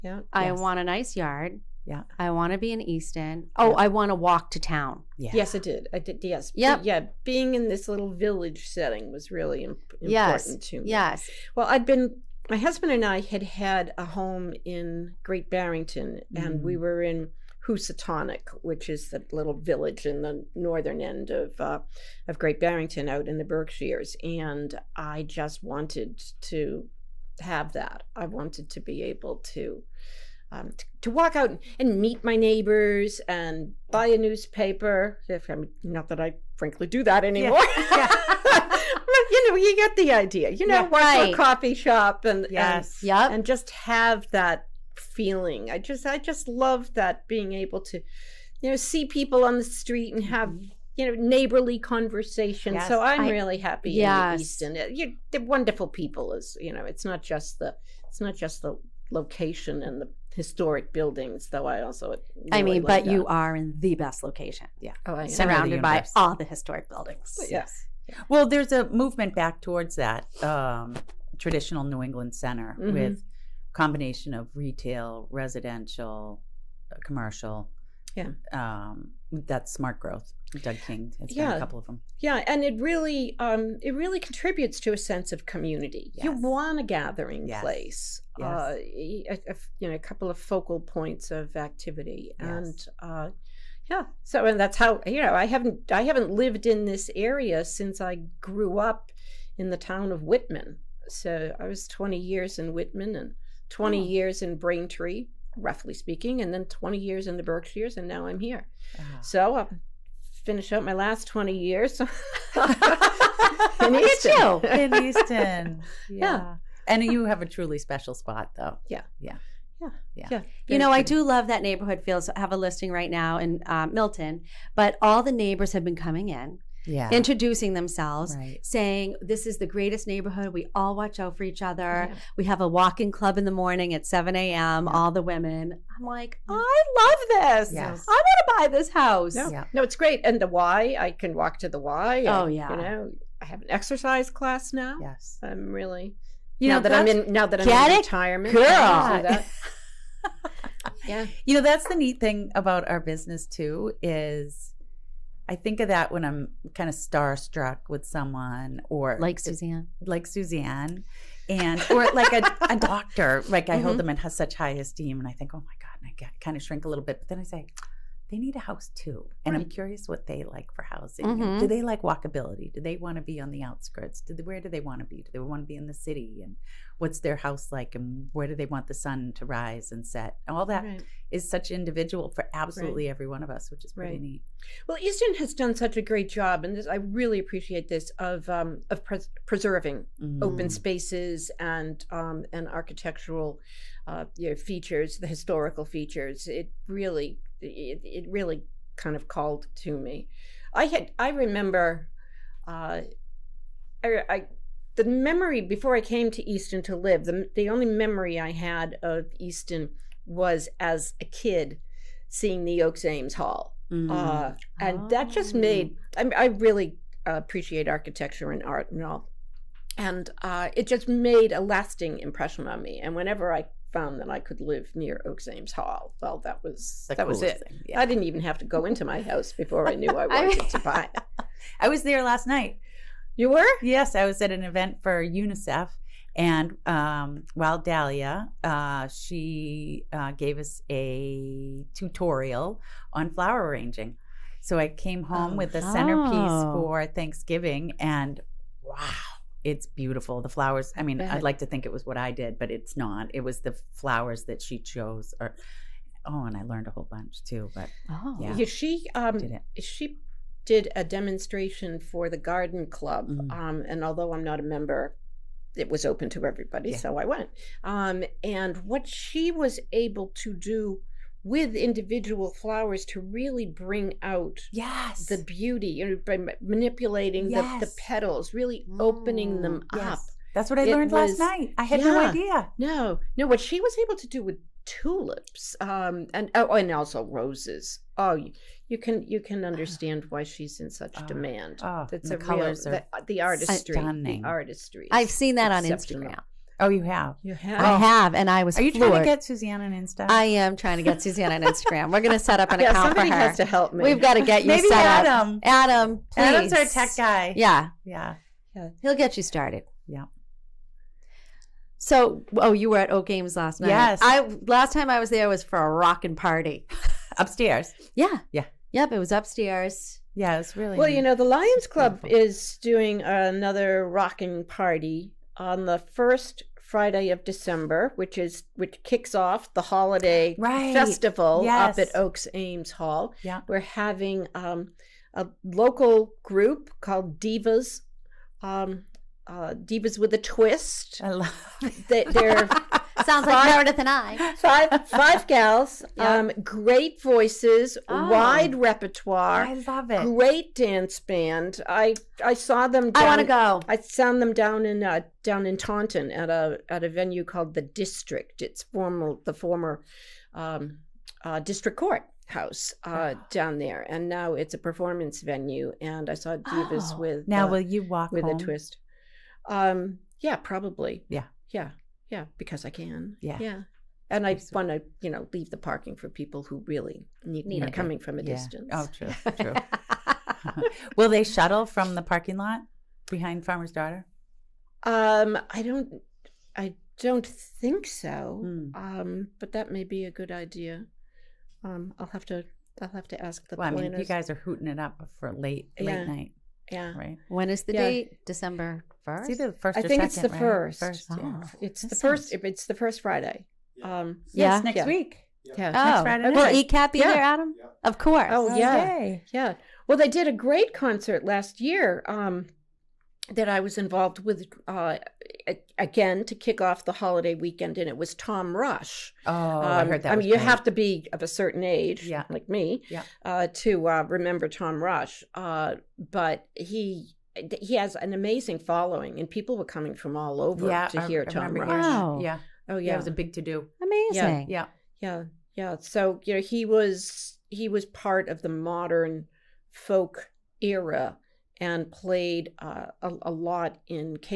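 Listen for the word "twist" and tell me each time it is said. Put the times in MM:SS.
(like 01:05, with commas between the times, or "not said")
05:40, 06:08.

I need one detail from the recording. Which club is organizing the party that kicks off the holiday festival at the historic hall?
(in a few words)
Lions Club.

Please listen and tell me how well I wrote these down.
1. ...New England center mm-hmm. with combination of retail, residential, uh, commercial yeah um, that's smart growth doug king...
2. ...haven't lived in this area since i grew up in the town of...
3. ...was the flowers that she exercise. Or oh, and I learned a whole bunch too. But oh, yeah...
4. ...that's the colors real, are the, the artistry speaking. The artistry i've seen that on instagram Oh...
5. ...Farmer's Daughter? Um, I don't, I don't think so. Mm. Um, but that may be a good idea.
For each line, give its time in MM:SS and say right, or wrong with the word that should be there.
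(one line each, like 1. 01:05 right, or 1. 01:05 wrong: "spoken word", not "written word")
1. 01:11 right
2. 01:36 right
3. 04:13 wrong: "chose", not "exercise"
4. 04:52 wrong: "stunning", not "speaking"
5. 06:23 right.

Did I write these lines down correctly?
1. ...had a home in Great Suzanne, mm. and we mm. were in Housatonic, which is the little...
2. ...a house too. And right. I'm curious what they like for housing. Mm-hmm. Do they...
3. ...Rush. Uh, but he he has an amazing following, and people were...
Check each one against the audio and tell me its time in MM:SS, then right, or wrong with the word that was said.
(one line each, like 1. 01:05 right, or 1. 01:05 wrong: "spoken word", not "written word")
1. 00:13 wrong: "Barrington", not "Suzanne"
2. 02:48 right
3. 07:05 right.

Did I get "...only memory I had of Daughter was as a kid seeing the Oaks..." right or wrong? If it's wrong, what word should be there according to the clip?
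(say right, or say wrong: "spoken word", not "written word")
wrong: "Easton", not "Daughter".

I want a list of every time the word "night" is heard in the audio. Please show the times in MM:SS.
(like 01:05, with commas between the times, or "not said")
03:52, 04:41, 05:13, 06:36.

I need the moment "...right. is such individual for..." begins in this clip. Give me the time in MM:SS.
03:00.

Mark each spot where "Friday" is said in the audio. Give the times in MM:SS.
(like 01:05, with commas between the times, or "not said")
05:26, 06:43.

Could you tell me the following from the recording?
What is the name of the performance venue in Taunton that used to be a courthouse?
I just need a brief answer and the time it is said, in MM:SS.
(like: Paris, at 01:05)
The District, at 05:57.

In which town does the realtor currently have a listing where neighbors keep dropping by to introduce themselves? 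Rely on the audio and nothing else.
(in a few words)
Milton.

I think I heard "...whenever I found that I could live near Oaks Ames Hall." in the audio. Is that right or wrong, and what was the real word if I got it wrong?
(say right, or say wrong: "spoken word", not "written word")
right.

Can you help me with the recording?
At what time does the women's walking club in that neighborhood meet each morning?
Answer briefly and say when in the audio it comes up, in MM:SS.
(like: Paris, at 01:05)
7 a.m., at 02:14.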